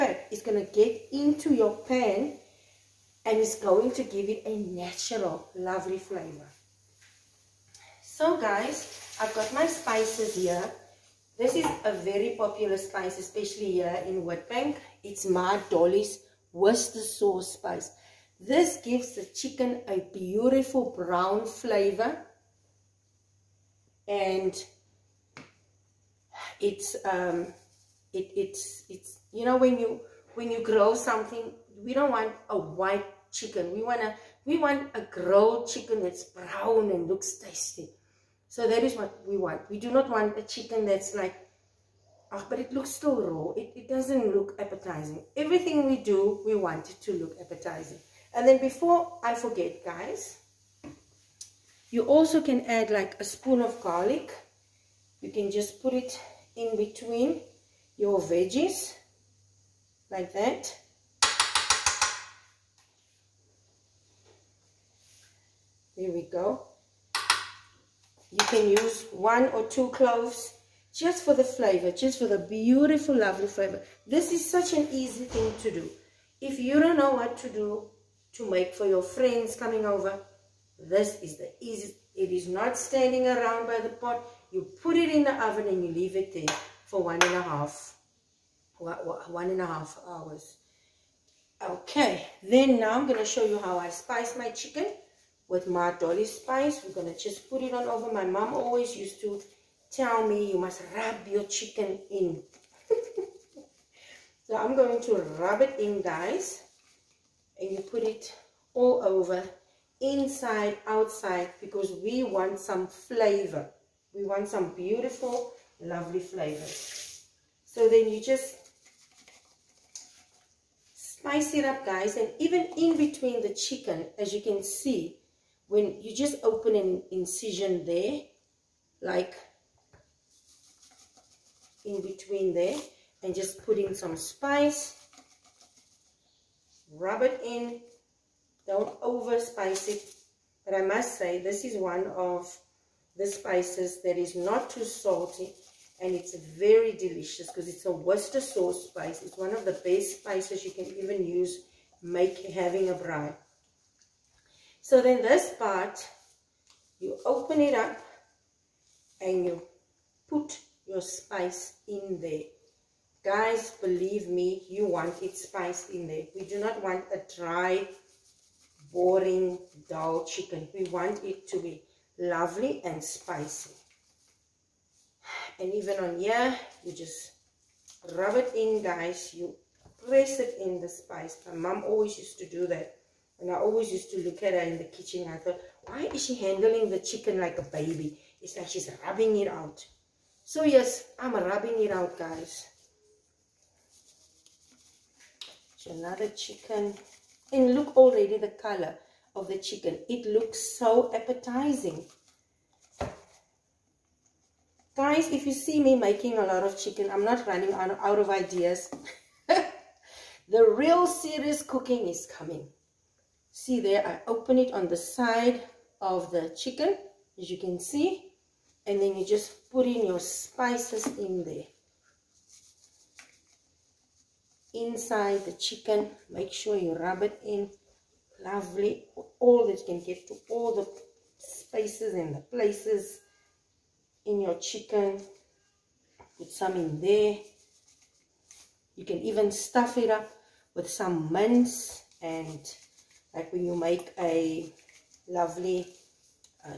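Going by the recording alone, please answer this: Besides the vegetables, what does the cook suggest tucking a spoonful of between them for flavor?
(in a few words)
Garlic.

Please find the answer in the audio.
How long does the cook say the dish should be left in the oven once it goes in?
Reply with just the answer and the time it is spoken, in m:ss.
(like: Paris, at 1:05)
1.5 hours, at 1:28.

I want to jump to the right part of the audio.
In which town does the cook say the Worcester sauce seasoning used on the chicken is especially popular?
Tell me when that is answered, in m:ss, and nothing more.
0:14.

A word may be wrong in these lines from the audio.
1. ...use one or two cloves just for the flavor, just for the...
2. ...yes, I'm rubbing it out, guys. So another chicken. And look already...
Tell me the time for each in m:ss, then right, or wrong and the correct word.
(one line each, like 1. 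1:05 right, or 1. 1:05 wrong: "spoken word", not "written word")
1. 1:08 right
2. 3:10 right.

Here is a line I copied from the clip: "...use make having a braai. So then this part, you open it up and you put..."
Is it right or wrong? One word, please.
right.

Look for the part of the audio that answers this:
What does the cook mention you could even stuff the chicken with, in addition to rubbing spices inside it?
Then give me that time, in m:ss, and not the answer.
4:01.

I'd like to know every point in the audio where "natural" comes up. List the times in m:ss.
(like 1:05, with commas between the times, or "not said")
0:04.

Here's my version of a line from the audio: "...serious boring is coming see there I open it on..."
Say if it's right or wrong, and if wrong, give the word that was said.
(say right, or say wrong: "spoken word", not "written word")
wrong: "cooking", not "boring".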